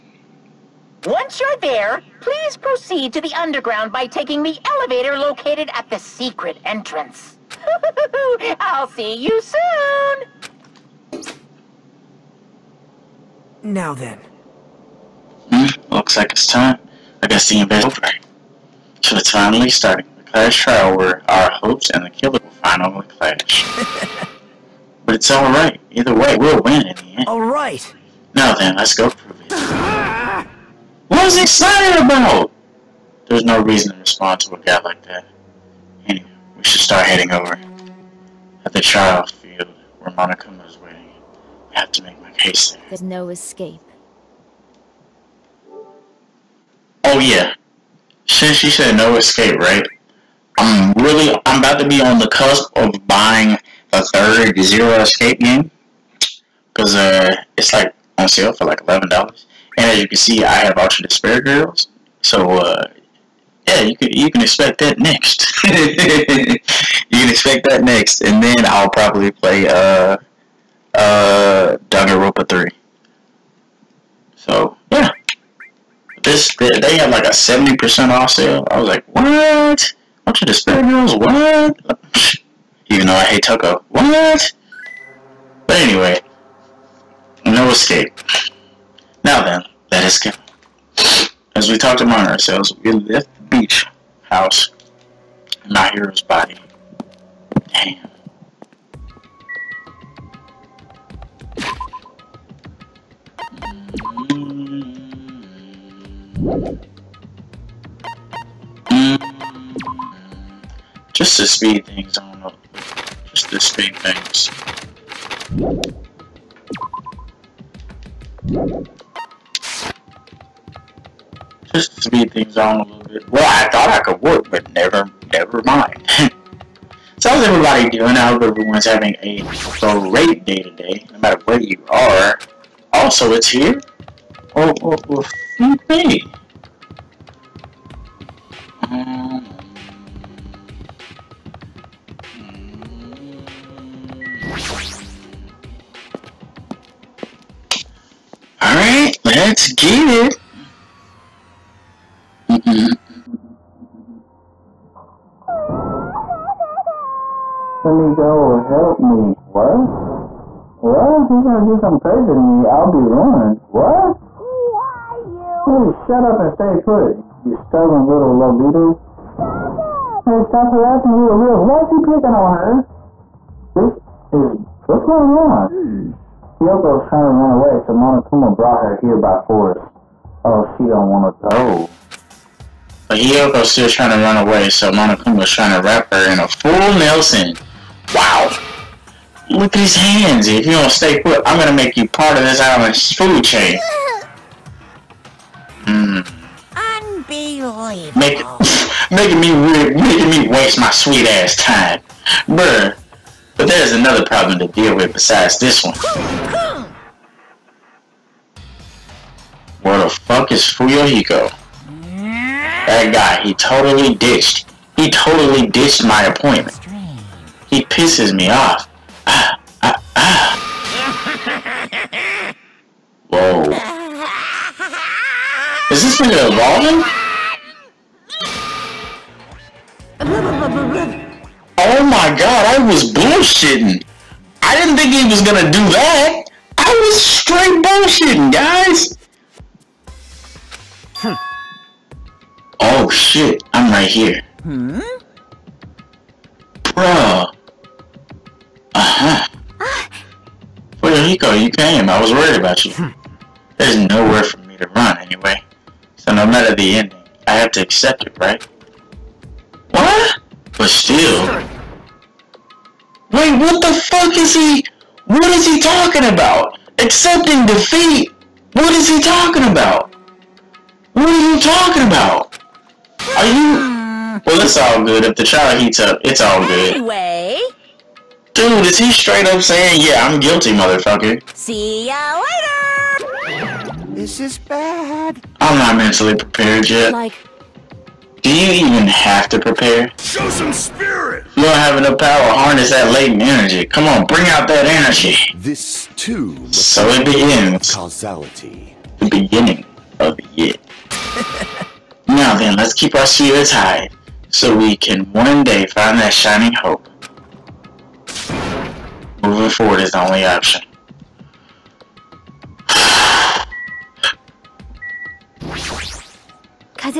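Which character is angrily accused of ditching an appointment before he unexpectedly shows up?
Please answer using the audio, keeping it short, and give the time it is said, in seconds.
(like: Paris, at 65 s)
Fuyuhiko, at 210 s.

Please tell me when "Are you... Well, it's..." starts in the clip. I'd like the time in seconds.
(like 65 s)
273 s.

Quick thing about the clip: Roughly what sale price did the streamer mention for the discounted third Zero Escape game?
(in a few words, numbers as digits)
$11.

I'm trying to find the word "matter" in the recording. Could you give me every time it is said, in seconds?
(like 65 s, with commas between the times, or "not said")
131 s, 256 s.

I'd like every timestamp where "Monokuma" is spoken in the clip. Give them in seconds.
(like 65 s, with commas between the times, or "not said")
177 s, 184 s.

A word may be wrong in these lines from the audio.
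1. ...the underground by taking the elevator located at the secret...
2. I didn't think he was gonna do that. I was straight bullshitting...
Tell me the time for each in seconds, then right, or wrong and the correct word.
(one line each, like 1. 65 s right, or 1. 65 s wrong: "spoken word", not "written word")
1. 3 s right
2. 234 s right.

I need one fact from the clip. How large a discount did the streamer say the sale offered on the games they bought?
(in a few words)
70%.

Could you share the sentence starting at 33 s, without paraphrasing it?
There's no reason to respond to a guy like that.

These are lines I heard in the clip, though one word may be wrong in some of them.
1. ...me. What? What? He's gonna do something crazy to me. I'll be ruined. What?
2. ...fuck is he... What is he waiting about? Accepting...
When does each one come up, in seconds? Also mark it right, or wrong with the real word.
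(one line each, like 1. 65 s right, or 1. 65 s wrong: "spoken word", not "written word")
1. 159 s right
2. 263 s wrong: "talking", not "waiting".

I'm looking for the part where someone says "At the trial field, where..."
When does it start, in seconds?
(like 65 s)
38 s.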